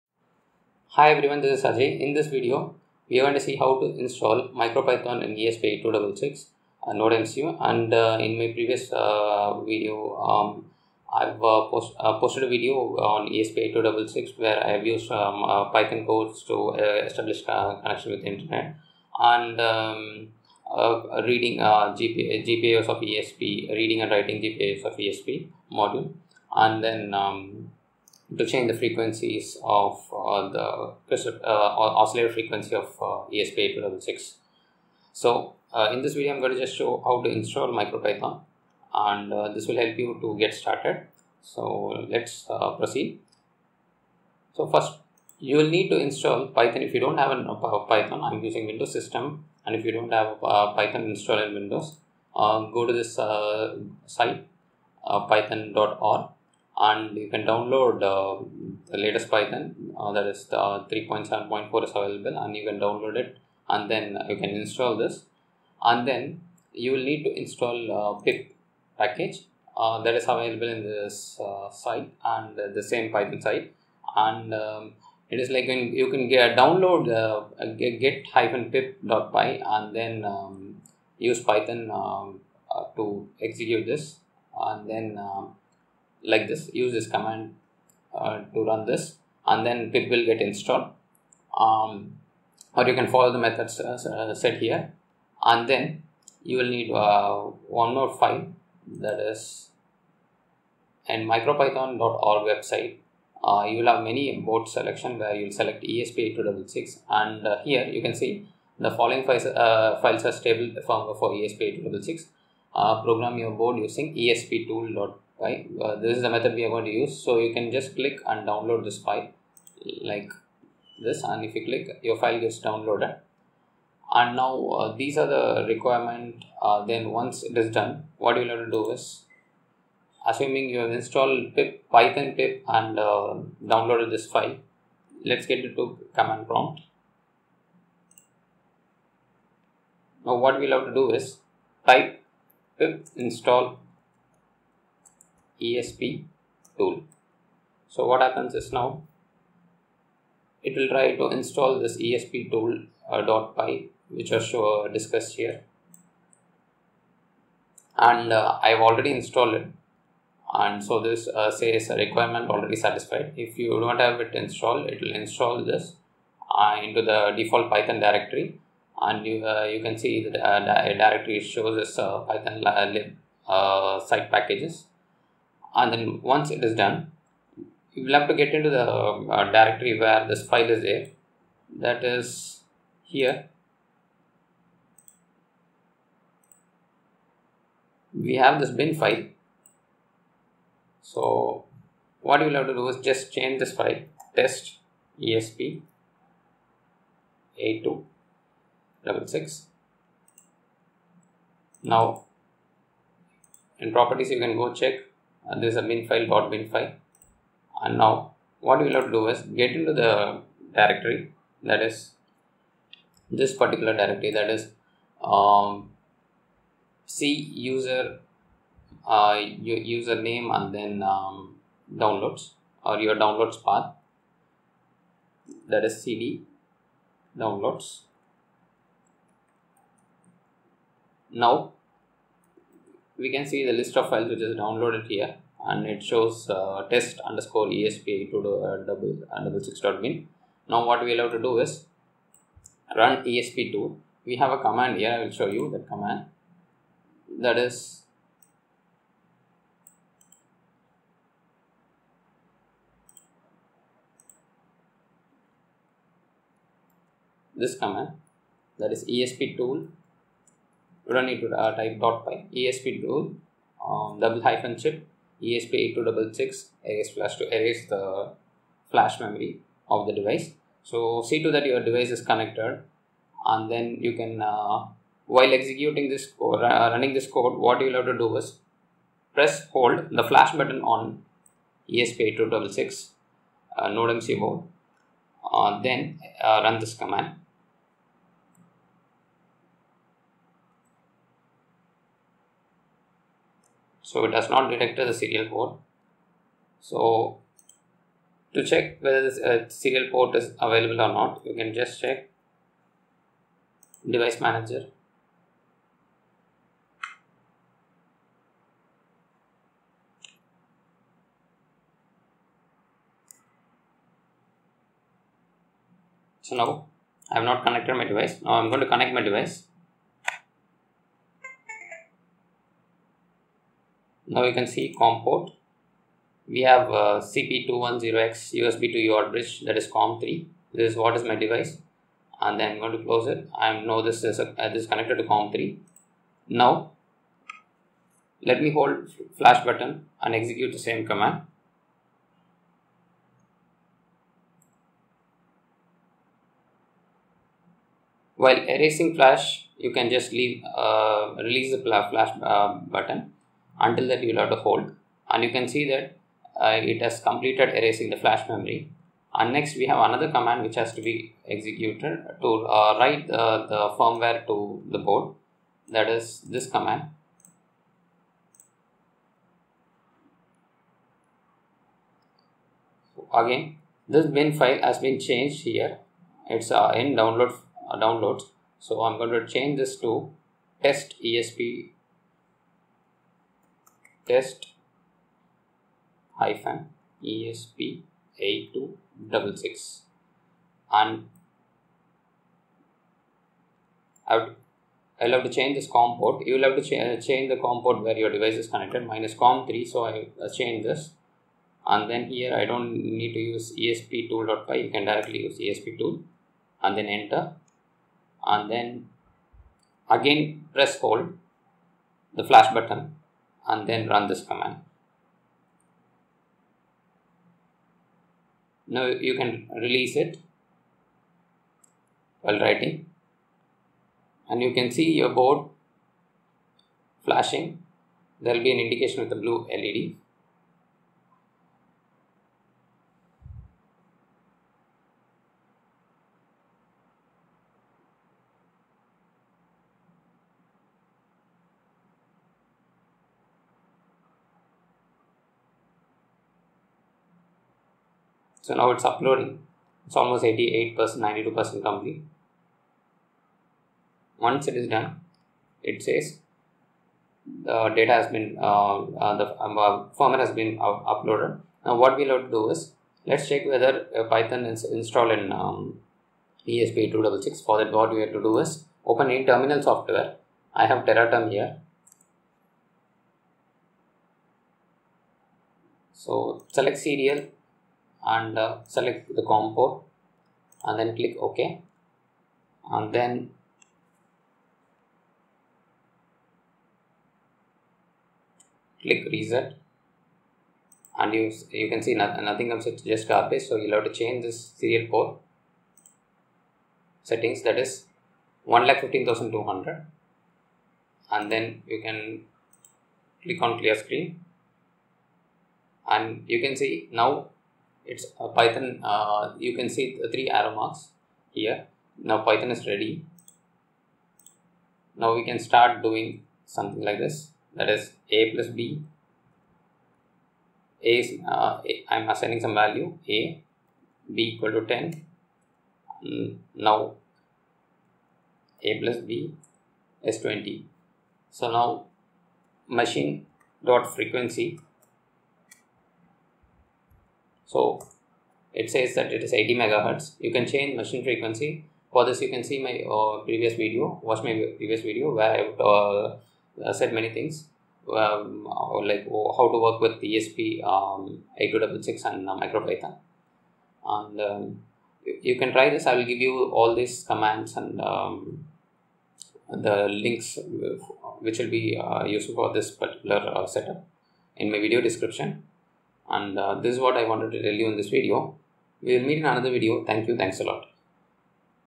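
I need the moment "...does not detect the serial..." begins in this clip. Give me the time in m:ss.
4:54.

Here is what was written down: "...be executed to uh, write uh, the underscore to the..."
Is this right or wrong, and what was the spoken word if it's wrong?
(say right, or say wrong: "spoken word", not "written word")
wrong: "firmware", not "underscore".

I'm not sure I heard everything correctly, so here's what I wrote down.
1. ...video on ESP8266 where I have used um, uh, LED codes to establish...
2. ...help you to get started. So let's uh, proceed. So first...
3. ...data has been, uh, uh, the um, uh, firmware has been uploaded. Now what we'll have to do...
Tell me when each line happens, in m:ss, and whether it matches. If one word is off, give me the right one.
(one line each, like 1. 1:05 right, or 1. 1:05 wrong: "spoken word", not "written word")
1. 0:12 wrong: "Python", not "LED"
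2. 0:39 right
3. 7:37 right.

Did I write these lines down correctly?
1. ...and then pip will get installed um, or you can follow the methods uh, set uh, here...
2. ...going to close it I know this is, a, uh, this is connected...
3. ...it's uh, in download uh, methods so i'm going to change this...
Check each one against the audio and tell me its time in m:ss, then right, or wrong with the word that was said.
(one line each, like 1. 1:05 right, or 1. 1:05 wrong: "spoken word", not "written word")
1. 1:29 right
2. 5:32 right
3. 6:16 wrong: "downloads", not "methods".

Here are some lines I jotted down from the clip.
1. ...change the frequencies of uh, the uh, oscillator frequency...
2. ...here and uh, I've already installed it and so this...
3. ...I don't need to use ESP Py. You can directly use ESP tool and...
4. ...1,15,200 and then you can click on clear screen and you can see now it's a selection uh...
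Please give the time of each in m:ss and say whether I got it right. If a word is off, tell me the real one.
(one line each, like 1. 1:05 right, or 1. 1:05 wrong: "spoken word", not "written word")
1. 0:28 right
2. 2:35 right
3. 6:42 right
4. 8:18 wrong: "python", not "selection".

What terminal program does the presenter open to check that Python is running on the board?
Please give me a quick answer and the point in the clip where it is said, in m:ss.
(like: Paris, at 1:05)
Tera Term, at 7:51.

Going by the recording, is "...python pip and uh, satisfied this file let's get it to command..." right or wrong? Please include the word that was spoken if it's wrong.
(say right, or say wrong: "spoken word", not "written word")
wrong: "downloaded", not "satisfied".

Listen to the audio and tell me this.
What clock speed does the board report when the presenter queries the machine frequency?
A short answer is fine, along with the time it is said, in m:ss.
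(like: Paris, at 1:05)
80 megahertz, at 8:59.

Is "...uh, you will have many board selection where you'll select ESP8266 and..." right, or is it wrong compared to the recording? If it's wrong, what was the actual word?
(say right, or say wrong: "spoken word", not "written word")
right.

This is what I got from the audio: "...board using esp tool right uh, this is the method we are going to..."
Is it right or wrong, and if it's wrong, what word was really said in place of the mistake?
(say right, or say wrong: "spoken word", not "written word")
right.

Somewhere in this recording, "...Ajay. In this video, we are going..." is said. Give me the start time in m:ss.
0:01.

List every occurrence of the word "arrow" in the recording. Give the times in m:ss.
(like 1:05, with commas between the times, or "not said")
8:30.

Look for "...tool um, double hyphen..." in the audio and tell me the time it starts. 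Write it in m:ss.
4:23.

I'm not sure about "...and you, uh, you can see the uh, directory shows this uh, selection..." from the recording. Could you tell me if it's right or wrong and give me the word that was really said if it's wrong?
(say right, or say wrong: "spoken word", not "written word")
wrong: "python", not "selection".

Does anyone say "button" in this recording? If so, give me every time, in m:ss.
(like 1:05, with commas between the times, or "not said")
4:40, 5:39, 5:52, 6:52.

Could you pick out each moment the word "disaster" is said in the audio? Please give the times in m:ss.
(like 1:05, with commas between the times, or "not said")
not said.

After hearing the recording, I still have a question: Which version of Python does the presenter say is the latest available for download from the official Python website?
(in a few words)
3.7.4.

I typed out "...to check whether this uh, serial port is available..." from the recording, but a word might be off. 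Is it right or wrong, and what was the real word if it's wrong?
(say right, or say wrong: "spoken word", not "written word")
right.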